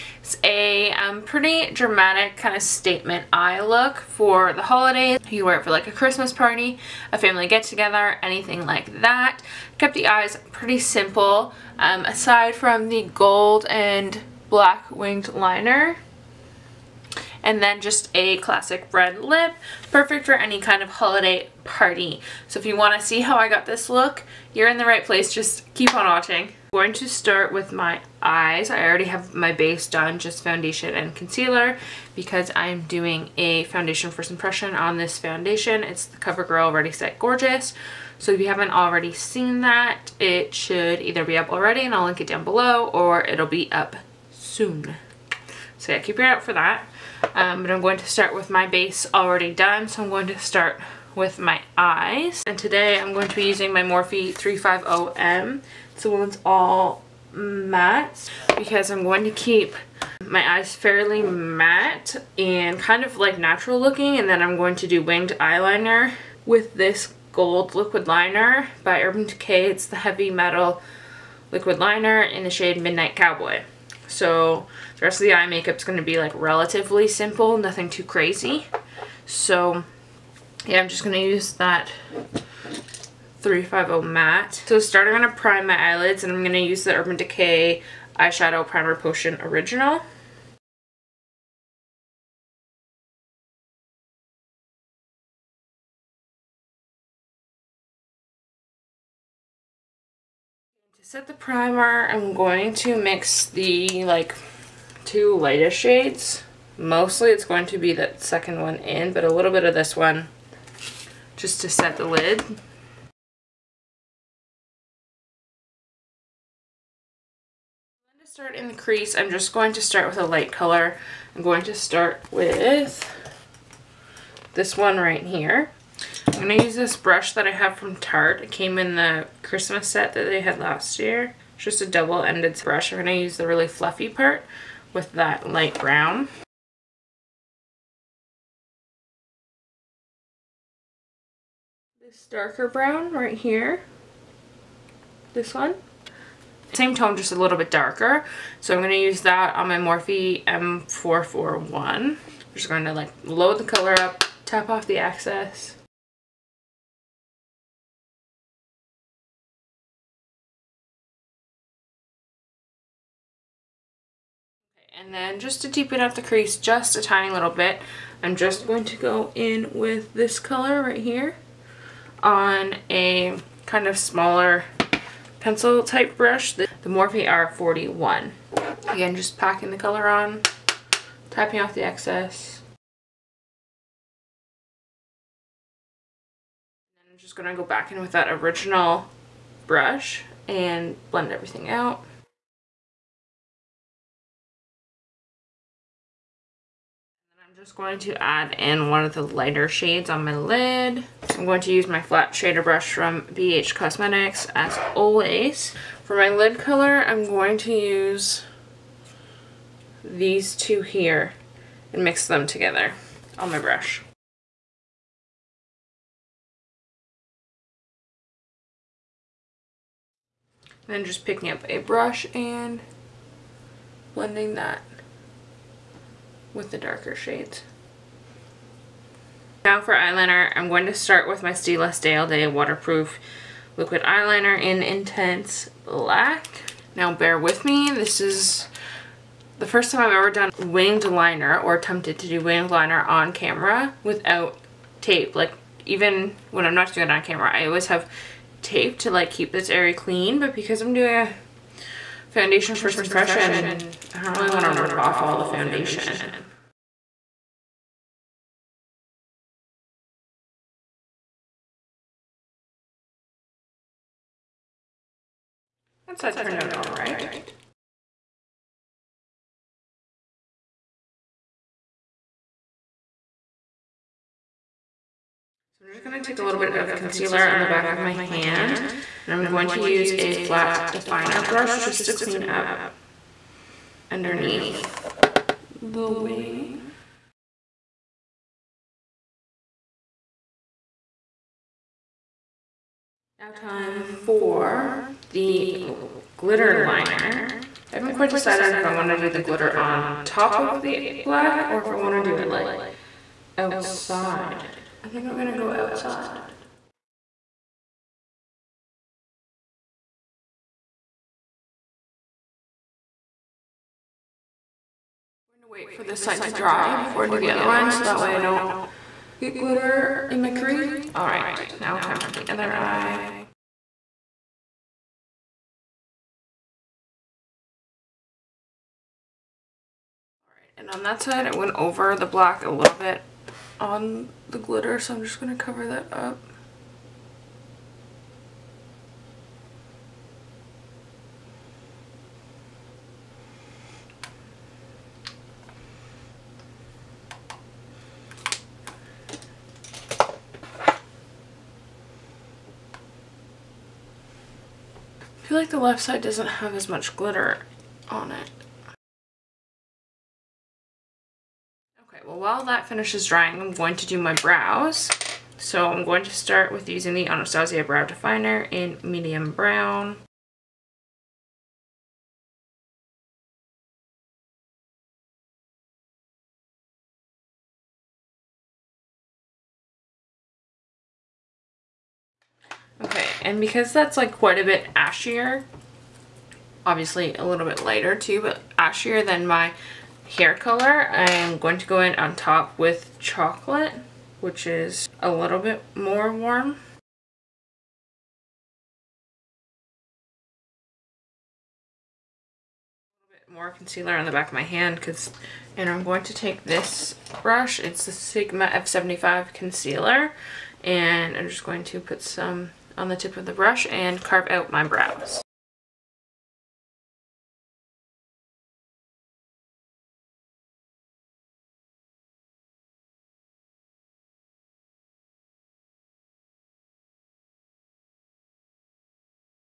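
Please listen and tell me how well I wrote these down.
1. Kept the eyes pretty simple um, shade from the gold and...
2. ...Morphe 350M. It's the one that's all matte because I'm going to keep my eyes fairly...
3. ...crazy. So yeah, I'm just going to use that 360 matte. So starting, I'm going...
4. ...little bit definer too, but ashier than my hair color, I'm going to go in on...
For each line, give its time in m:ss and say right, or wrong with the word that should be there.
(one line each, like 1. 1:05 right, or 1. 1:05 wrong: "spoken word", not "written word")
1. 0:09 wrong: "aside", not "shade"
2. 0:53 right
3. 1:18 wrong: "350", not "360"
4. 6:27 wrong: "lighter", not "definer".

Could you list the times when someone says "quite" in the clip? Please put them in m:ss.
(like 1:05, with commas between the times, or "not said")
4:58, 6:24.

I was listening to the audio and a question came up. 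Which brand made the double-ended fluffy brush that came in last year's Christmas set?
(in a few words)
Tarte.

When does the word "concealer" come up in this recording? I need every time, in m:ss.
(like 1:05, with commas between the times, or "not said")
0:31, 4:36, 6:43, 6:49.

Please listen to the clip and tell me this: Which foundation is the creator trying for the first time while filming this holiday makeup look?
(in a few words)
CoverGirl Ready Set Gorgeous.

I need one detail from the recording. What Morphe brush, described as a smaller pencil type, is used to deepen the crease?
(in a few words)
Morphe R41.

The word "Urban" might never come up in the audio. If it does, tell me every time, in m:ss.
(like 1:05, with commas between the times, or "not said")
1:09, 1:26.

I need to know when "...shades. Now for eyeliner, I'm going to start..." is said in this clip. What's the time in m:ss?
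3:47.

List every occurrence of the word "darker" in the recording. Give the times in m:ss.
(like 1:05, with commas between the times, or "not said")
2:22, 2:27, 3:46.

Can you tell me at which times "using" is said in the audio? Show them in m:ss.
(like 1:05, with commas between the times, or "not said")
0:53, 6:06.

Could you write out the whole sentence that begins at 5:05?
I think I'm going to go outside.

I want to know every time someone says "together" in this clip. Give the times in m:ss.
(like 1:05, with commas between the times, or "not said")
0:07, 3:32.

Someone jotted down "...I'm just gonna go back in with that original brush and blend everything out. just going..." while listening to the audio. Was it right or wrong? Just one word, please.
right.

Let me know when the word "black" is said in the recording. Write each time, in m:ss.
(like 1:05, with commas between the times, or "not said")
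0:14, 3:55, 5:01, 5:32.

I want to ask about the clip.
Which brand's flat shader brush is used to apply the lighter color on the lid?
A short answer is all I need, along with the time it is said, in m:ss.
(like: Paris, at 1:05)
BH Cosmetics, at 3:23.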